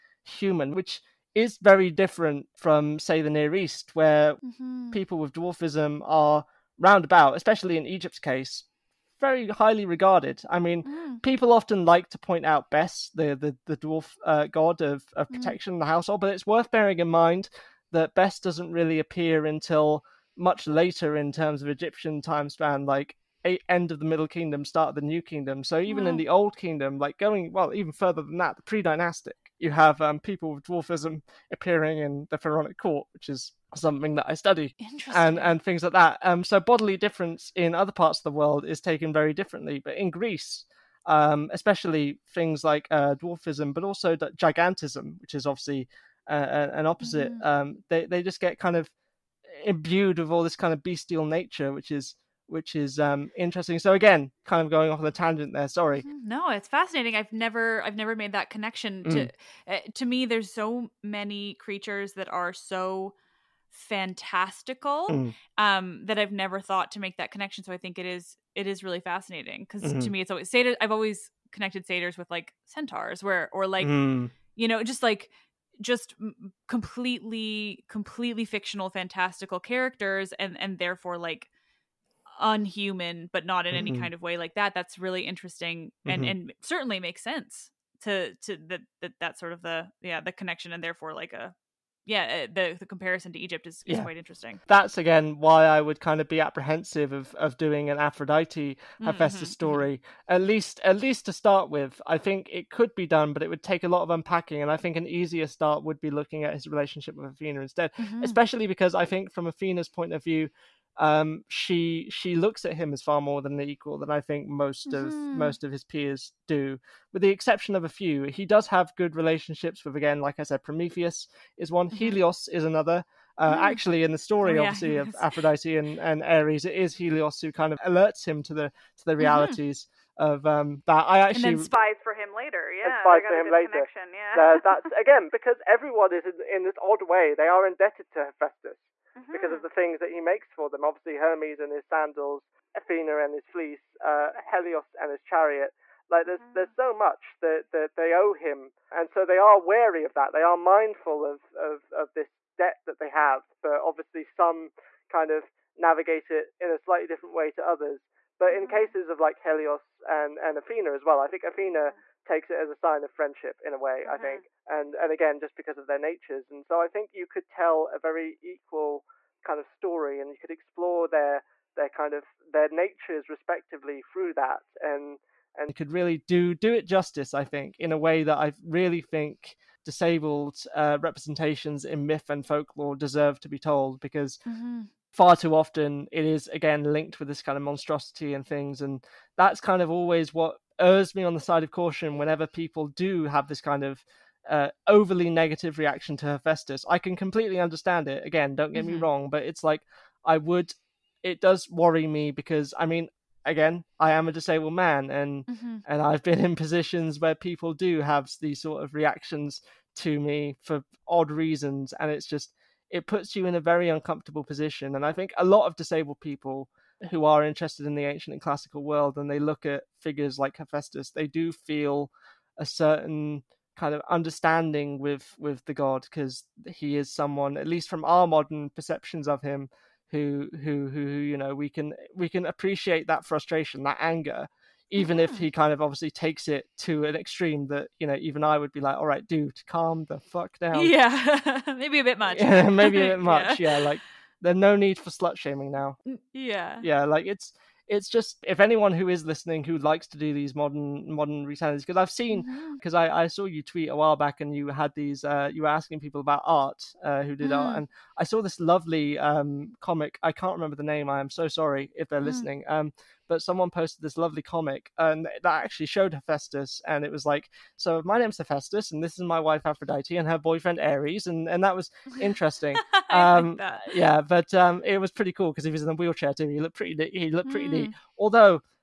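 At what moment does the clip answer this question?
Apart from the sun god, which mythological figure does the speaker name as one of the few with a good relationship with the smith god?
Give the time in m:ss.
2:00.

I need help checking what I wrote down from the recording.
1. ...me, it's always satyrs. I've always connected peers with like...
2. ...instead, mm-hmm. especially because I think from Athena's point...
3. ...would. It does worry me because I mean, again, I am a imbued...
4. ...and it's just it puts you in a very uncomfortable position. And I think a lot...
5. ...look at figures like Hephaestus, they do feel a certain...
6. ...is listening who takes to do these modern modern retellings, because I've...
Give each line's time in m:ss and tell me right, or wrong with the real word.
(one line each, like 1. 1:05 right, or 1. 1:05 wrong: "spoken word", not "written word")
1. 1:10 wrong: "satyrs", not "peers"
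2. 1:47 right
3. 3:20 wrong: "disabled", not "imbued"
4. 3:31 right
5. 3:39 right
6. 4:09 wrong: "likes", not "takes".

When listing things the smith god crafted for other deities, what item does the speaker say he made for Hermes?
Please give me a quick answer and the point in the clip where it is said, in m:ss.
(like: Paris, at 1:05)
Sandals, at 2:21.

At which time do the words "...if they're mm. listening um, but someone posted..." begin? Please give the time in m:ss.
4:21.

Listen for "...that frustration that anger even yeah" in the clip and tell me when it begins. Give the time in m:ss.
3:53.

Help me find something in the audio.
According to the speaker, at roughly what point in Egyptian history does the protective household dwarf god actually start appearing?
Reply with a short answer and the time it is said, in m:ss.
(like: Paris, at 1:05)
End of the Middle Kingdom, at 0:23.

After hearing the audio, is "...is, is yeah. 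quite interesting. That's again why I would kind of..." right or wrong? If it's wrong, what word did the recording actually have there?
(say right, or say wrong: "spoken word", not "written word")
right.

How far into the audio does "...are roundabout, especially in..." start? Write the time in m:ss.
0:06.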